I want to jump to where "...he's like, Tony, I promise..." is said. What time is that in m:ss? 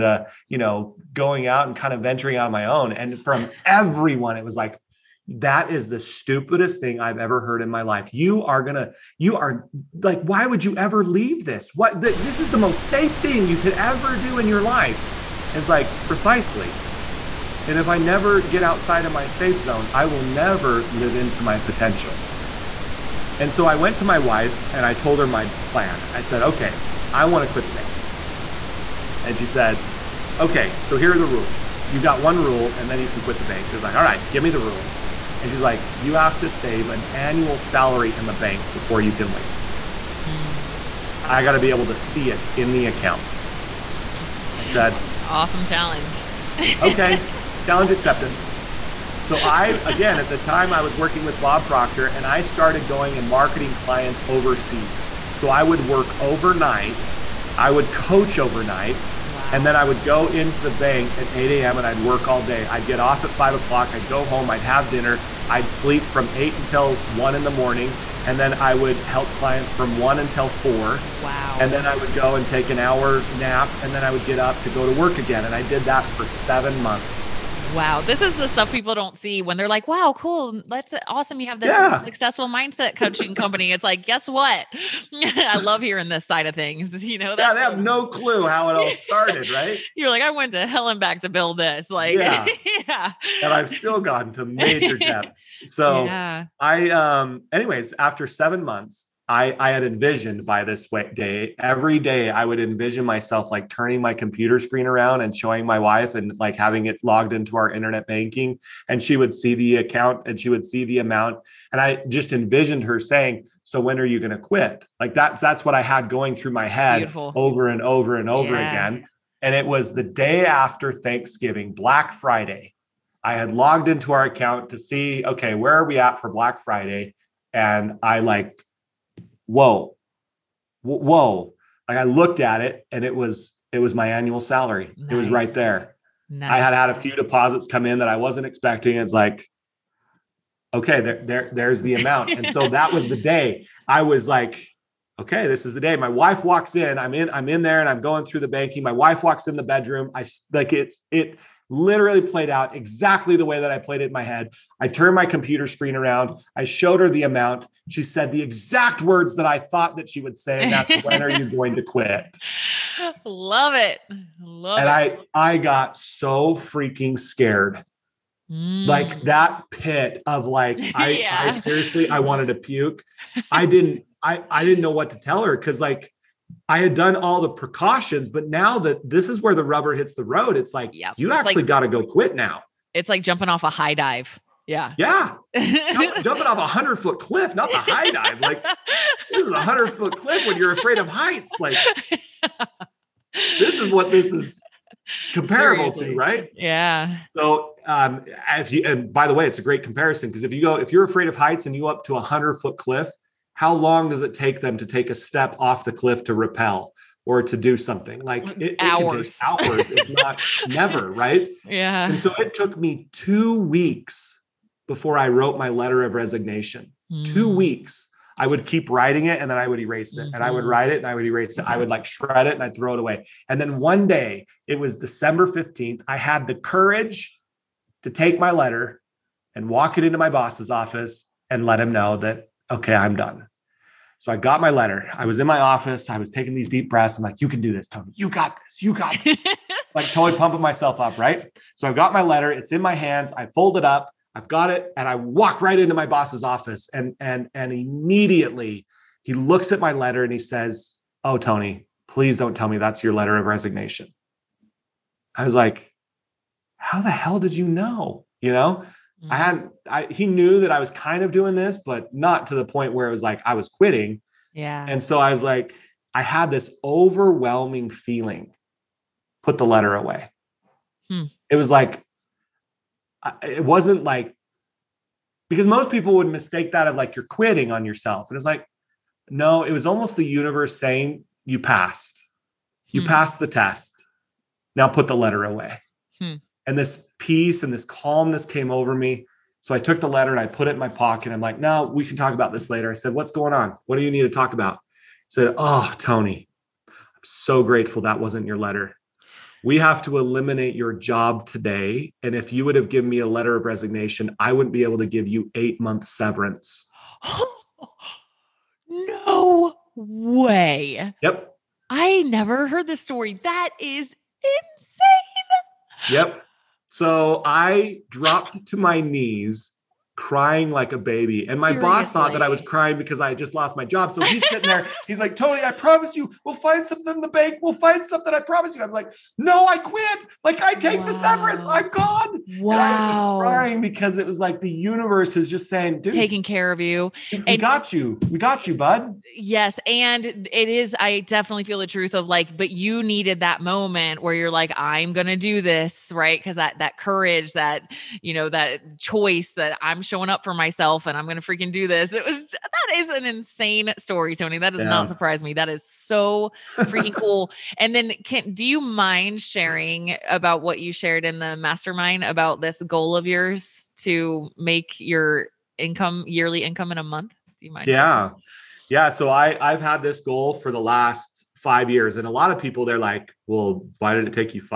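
5:25.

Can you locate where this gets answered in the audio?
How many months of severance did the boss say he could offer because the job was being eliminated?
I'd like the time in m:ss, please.
5:05.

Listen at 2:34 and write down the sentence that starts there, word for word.
I turned my computer screen around.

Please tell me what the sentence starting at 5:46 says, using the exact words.
Because that that courage, that, you know, that choice that I'm showing up for myself and I'm going to freaking do this.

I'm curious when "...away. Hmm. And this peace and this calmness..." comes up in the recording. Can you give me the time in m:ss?
4:45.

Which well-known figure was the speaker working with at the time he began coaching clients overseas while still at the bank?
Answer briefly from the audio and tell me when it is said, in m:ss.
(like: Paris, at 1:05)
Bob Proctor, at 0:51.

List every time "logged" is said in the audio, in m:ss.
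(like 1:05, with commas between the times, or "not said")
1:47, 2:03.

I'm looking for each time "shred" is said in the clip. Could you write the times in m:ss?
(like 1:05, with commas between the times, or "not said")
3:42.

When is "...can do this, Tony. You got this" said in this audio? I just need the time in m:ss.
3:57.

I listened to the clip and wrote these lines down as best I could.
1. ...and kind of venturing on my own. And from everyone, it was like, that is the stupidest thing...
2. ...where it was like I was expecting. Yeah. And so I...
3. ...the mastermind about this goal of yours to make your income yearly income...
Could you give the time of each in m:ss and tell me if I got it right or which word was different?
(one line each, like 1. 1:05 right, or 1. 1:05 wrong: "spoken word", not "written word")
1. 0:01 right
2. 4:22 wrong: "quitting", not "expecting"
3. 6:01 right.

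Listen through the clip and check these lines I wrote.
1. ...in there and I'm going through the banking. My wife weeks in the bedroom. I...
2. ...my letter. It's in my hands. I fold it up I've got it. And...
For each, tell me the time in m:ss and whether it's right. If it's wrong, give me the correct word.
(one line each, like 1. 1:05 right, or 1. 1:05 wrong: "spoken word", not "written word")
1. 2:27 wrong: "walks", not "weeks"
2. 4:02 right.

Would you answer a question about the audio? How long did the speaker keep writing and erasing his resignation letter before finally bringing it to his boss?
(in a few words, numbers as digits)
2 weeks.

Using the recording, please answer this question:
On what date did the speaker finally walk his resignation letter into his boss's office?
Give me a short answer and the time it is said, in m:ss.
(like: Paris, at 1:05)
December 15th, at 3:44.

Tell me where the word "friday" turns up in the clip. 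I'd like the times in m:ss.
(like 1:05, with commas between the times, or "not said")
2:02, 2:06.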